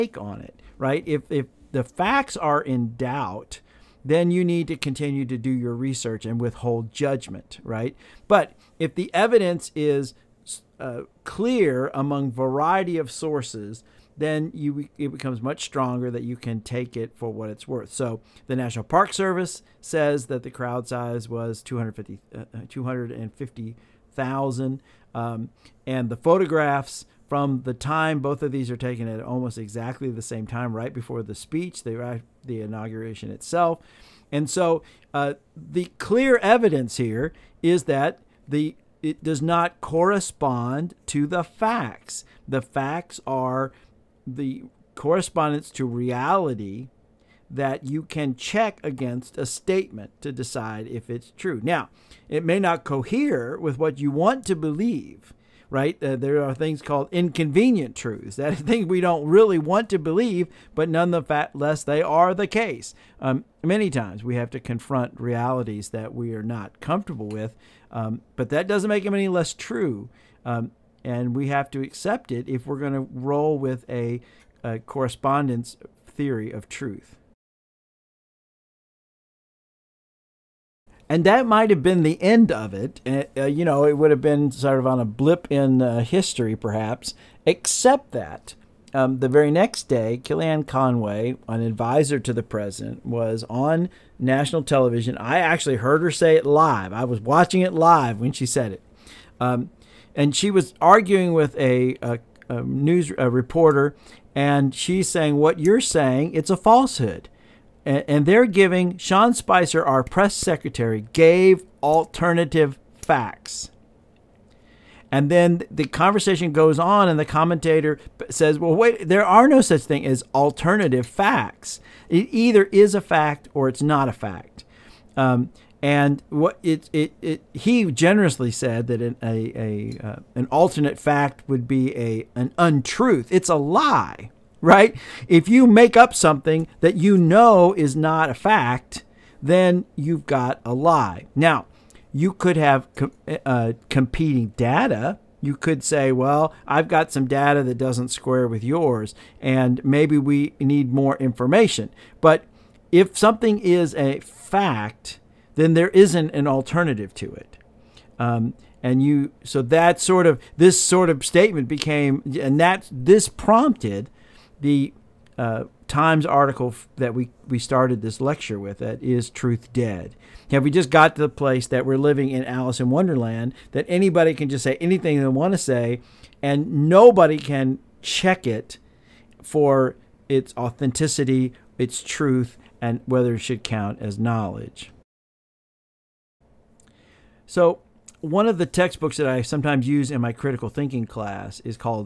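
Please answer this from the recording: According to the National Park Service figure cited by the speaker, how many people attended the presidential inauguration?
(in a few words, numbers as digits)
250,000.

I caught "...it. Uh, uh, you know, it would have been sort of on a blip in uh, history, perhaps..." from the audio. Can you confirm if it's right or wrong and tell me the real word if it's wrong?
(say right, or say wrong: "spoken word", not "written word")
right.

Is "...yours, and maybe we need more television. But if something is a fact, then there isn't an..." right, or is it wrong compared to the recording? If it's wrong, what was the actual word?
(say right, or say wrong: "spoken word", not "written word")
wrong: "information", not "television".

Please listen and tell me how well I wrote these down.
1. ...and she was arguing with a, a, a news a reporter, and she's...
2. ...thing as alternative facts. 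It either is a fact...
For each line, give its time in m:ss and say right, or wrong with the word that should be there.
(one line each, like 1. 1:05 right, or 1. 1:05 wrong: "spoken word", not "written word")
1. 1:40 right
2. 1:59 right.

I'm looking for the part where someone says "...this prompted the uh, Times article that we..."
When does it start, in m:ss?
2:42.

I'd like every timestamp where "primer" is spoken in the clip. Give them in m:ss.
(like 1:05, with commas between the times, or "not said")
not said.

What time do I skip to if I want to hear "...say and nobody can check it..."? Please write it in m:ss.
2:55.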